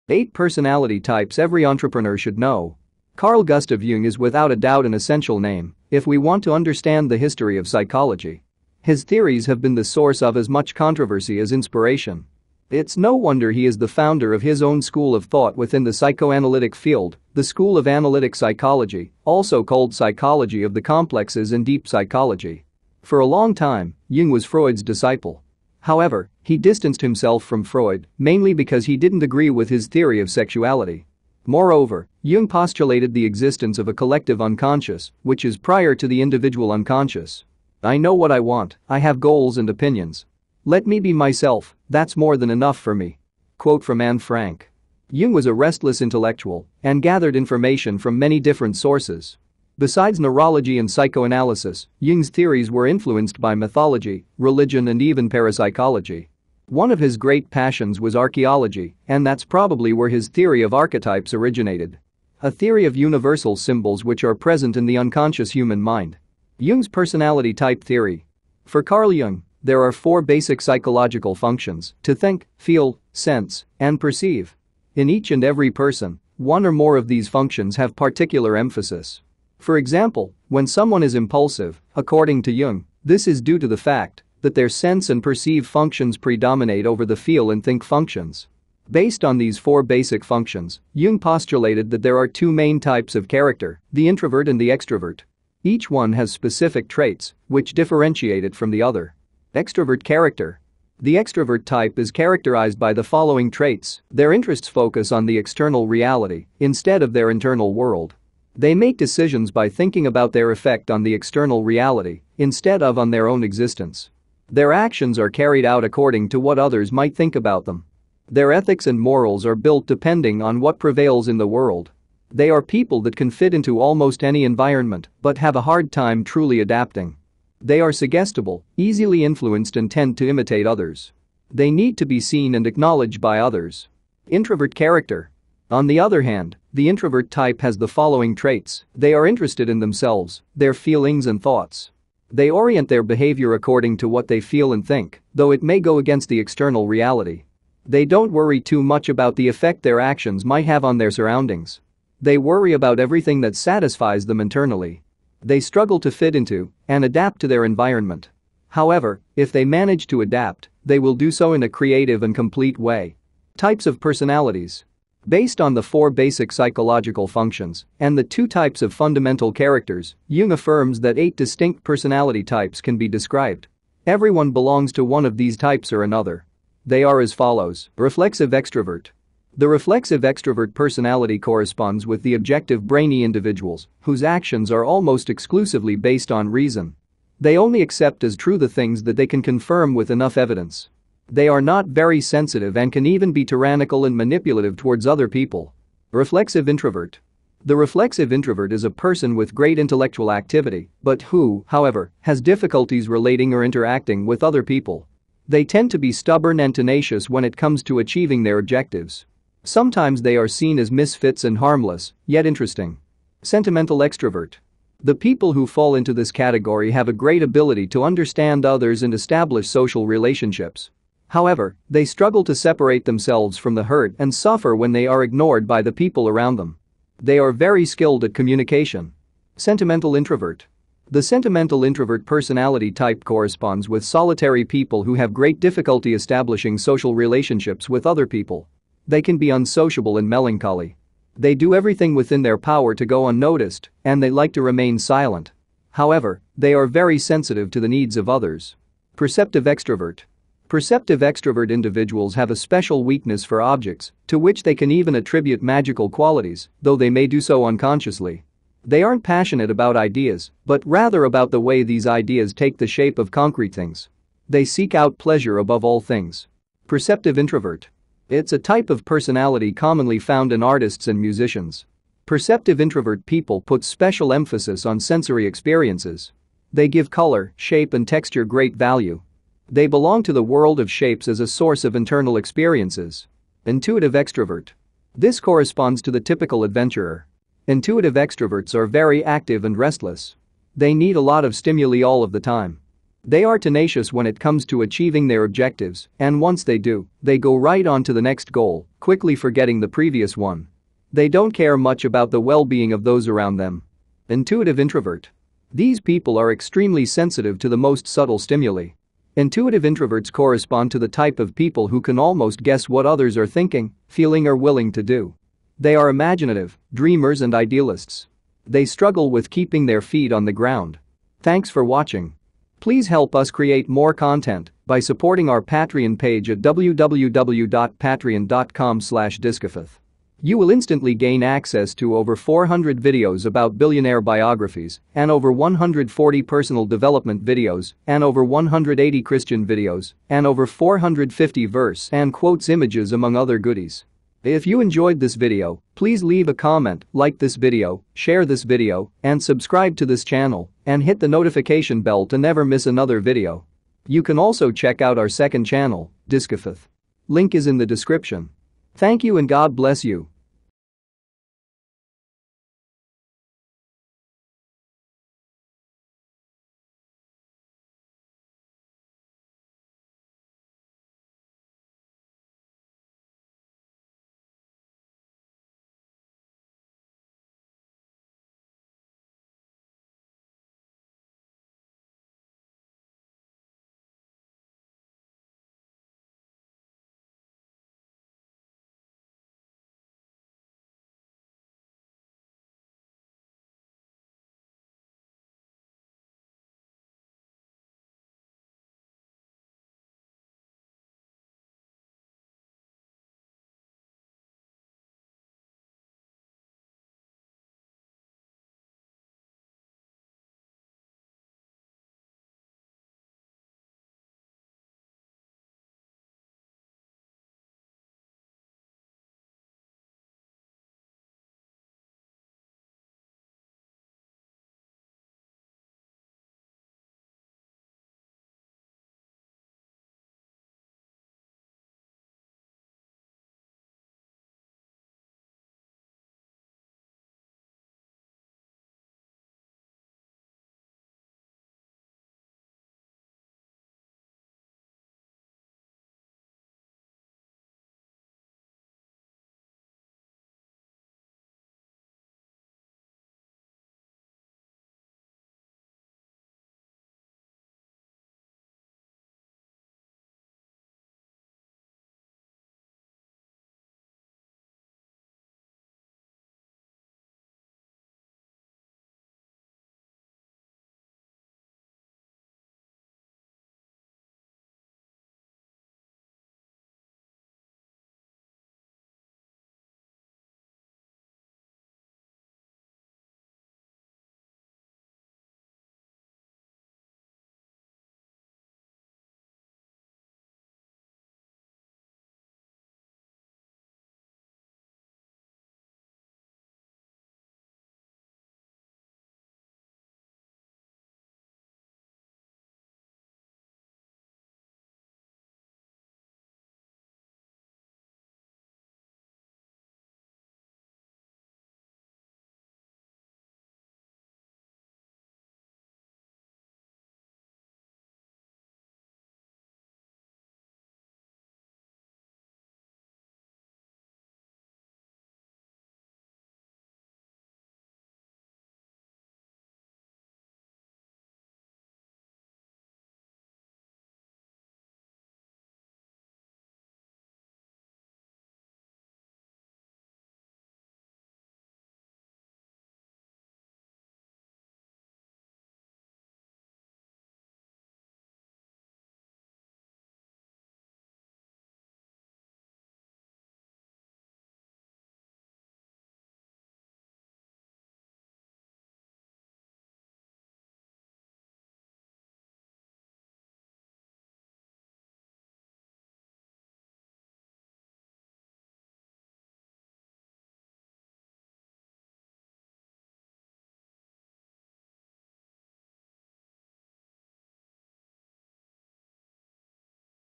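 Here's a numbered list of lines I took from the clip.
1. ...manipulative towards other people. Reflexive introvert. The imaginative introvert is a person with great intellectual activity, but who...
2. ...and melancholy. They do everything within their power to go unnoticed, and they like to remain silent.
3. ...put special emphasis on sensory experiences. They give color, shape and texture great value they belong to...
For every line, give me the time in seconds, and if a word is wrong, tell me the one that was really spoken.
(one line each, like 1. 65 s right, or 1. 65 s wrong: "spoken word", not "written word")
1. 194 s wrong: "reflexive", not "imaginative"
2. 240 s right
3. 273 s right.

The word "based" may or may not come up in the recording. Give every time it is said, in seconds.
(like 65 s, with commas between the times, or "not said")
88 s, 165 s, 185 s.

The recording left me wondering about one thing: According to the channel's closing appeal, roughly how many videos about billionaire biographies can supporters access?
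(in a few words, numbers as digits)
400.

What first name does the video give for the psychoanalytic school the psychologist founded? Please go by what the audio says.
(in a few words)
School of Analytic Psychology.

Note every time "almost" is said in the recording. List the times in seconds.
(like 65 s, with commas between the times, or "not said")
123 s, 184 s, 312 s.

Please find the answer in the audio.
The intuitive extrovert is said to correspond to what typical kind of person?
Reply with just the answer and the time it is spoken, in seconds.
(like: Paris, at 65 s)
adventurer, at 286 s.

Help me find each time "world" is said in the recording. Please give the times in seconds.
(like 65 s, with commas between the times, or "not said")
107 s, 121 s, 280 s.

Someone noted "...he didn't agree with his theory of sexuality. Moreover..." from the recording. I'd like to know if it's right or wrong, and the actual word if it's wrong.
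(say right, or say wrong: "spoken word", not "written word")
right.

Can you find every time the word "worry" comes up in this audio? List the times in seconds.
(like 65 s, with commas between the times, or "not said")
148 s, 152 s.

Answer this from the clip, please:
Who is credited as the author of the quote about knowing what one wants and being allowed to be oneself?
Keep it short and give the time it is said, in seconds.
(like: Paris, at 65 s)
Anne Frank, at 44 s.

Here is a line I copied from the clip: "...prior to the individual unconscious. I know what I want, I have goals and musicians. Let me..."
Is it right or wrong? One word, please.
wrong.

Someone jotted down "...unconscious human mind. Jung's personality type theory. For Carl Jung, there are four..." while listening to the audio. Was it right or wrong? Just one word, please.
right.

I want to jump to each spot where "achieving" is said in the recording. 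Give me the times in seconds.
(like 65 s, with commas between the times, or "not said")
207 s, 294 s.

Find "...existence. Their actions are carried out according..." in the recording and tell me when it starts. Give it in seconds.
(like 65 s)
113 s.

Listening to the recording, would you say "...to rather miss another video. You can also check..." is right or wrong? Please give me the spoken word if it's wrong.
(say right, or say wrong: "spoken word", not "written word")
wrong: "never", not "rather".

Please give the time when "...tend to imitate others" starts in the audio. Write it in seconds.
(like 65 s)
129 s.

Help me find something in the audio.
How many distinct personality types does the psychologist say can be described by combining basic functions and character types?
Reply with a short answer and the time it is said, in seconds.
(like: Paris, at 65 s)
8, at 171 s.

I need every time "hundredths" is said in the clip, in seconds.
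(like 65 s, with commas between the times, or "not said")
not said.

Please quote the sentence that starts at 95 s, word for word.
Each one has specific traits which differentiate it from the other.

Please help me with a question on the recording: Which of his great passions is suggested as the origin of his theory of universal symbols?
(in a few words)
archaeology.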